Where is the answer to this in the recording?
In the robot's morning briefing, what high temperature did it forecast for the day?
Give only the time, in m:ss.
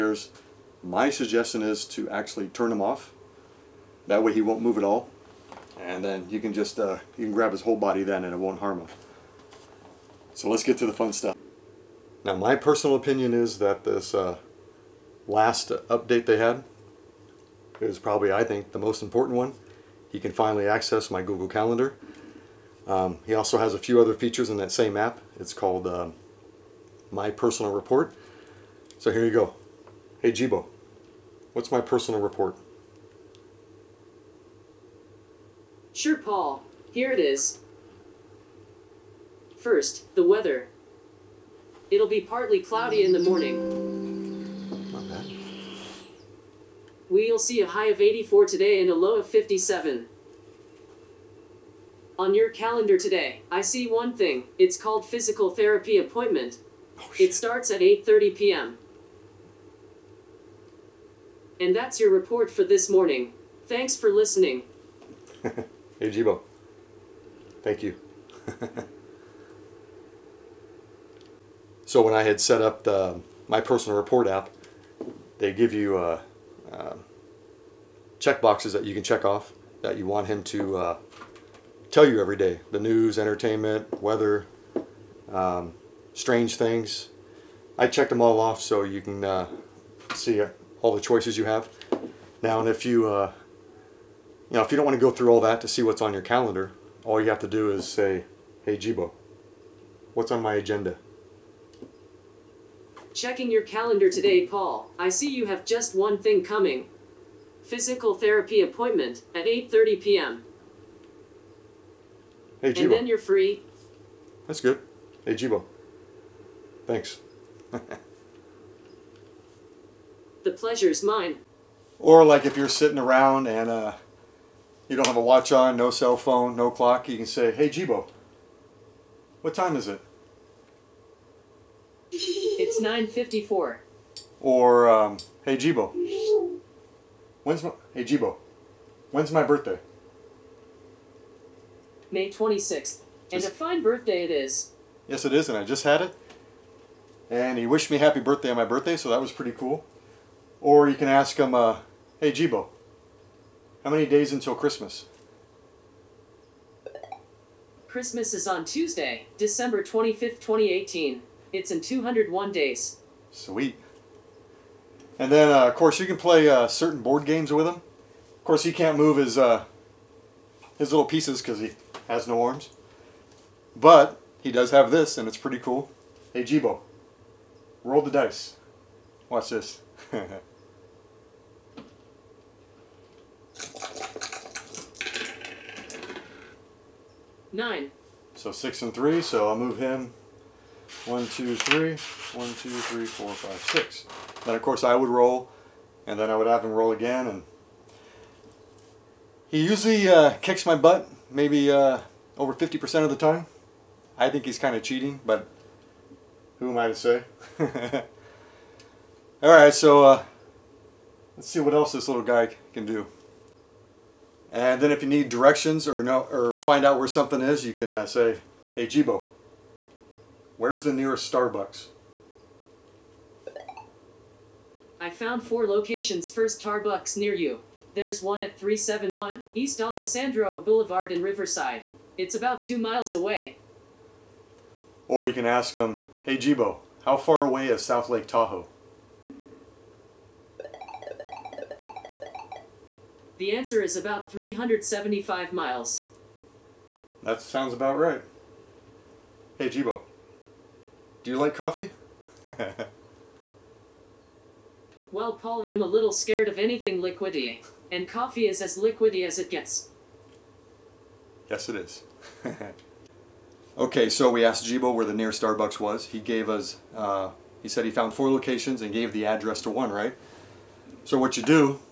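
0:48.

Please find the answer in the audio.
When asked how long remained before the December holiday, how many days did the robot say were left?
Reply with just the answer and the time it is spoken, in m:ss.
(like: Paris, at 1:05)
201, at 2:41.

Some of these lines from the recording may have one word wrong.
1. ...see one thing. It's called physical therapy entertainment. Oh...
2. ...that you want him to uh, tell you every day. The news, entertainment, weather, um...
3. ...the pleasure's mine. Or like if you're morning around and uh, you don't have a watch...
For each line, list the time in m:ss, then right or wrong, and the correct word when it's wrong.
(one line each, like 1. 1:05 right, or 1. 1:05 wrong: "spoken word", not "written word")
1. 0:53 wrong: "appointment", not "entertainment"
2. 1:19 right
3. 2:00 wrong: "sitting", not "morning".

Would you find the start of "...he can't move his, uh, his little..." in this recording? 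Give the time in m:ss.
2:48.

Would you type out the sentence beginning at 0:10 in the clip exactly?
So let's get to the fun stuff.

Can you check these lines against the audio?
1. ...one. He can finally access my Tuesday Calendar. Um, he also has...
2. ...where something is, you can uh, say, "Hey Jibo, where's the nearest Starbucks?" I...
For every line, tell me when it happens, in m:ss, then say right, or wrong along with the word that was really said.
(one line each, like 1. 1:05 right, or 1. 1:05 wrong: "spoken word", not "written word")
1. 0:19 wrong: "Google", not "Tuesday"
2. 3:36 right.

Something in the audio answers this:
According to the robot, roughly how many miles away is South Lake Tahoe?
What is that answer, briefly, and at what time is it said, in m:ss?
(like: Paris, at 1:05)
375, at 4:04.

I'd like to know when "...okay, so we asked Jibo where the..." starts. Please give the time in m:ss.
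4:23.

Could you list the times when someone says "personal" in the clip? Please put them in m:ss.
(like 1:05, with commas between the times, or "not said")
0:12, 0:27, 0:31, 1:13.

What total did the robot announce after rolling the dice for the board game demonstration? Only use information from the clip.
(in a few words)
9.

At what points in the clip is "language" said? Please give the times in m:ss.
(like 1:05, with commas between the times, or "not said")
not said.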